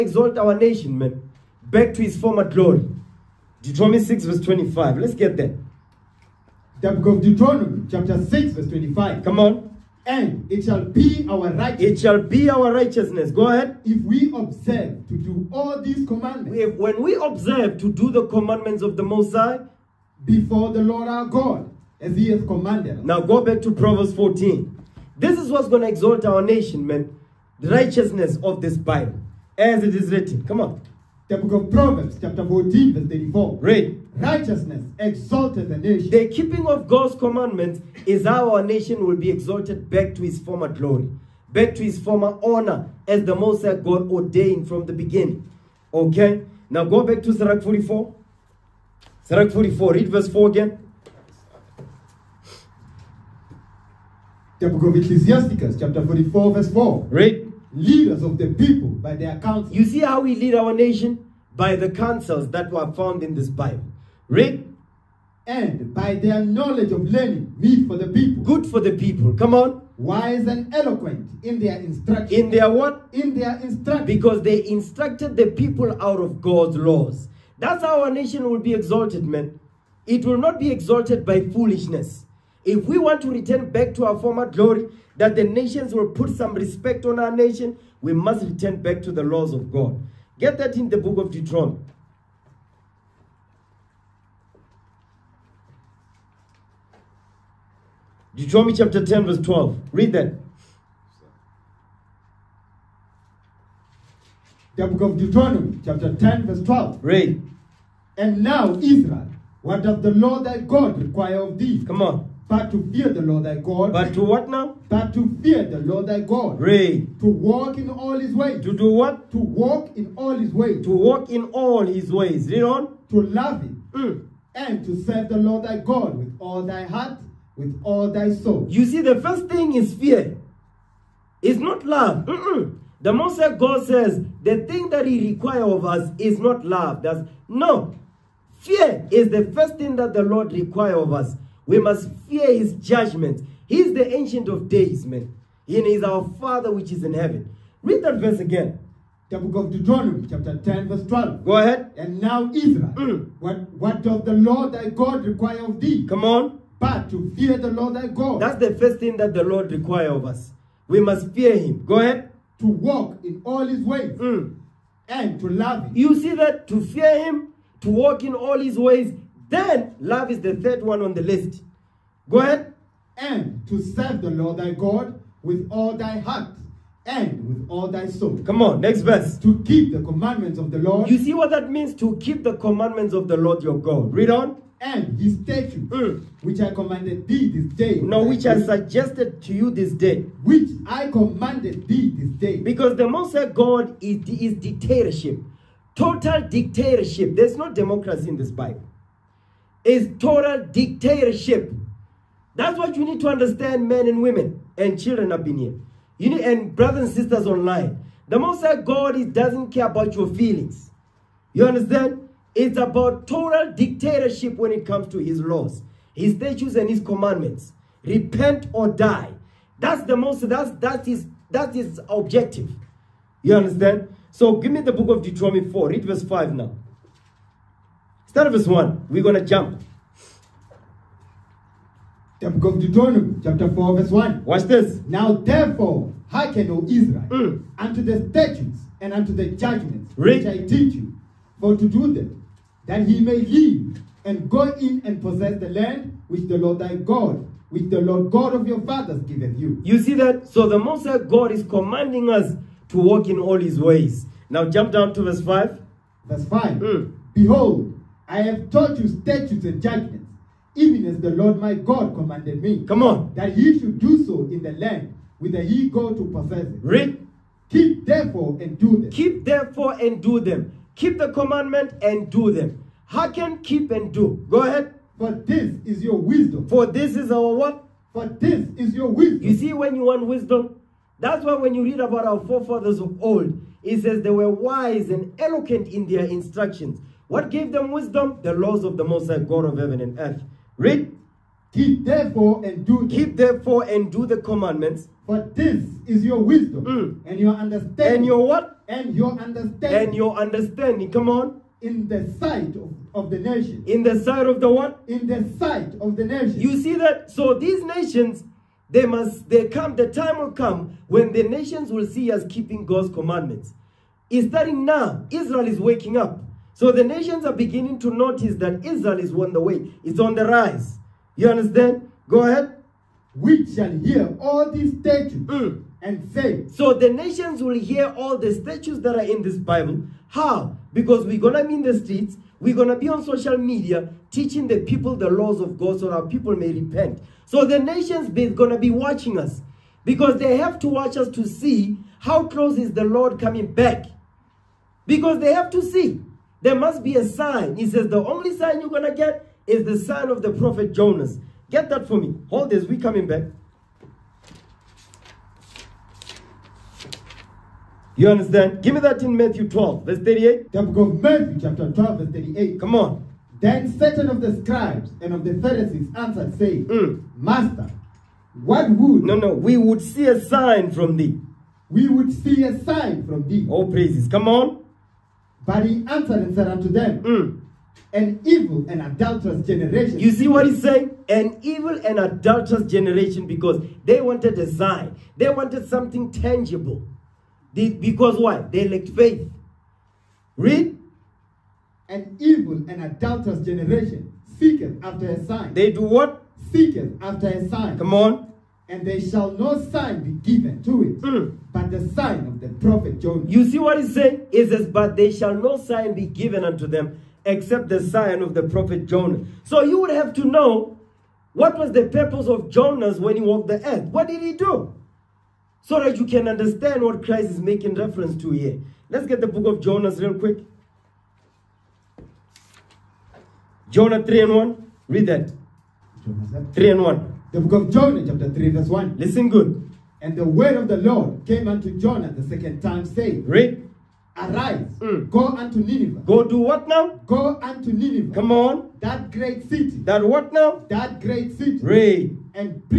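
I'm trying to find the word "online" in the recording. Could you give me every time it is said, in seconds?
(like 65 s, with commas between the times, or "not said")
207 s.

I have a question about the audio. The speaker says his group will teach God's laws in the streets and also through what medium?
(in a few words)
Social media.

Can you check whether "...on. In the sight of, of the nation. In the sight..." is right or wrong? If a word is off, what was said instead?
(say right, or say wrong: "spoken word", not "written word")
right.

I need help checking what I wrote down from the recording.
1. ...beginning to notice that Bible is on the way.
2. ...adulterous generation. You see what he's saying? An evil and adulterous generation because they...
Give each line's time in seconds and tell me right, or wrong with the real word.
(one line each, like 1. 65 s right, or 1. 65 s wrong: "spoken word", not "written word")
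1. 317 s wrong: "Israel", not "Bible"
2. 379 s right.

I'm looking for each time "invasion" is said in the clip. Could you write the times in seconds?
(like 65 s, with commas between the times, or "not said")
not said.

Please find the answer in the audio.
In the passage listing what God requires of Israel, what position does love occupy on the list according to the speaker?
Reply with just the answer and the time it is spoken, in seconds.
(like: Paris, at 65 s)
Third, at 170 s.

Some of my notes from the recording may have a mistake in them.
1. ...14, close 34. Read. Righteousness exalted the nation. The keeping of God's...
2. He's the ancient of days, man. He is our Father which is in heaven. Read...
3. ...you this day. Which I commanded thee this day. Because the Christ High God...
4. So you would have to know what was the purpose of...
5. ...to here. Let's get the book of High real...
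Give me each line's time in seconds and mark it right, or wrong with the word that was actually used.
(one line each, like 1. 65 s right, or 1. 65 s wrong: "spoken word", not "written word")
1. 32 s wrong: "verse", not "close"
2. 143 s right
3. 189 s wrong: "Most", not "Christ"
4. 409 s right
5. 418 s wrong: "Jonah", not "High".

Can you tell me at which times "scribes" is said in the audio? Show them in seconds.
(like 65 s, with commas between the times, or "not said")
364 s.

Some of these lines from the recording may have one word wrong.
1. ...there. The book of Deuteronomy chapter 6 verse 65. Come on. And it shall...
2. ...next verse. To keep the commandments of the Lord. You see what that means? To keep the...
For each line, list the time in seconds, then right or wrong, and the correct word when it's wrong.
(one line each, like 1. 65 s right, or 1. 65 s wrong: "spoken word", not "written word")
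1. 5 s wrong: "25", not "65"
2. 178 s right.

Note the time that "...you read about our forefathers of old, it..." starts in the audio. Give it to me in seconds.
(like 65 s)
281 s.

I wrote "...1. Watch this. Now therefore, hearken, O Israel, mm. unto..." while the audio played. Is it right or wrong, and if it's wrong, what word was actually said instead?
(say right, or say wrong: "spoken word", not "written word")
right.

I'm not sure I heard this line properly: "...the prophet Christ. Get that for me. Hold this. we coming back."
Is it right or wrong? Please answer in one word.
wrong.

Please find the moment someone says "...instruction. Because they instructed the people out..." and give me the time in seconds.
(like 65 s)
73 s.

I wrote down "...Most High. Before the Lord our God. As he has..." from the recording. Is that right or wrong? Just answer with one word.
right.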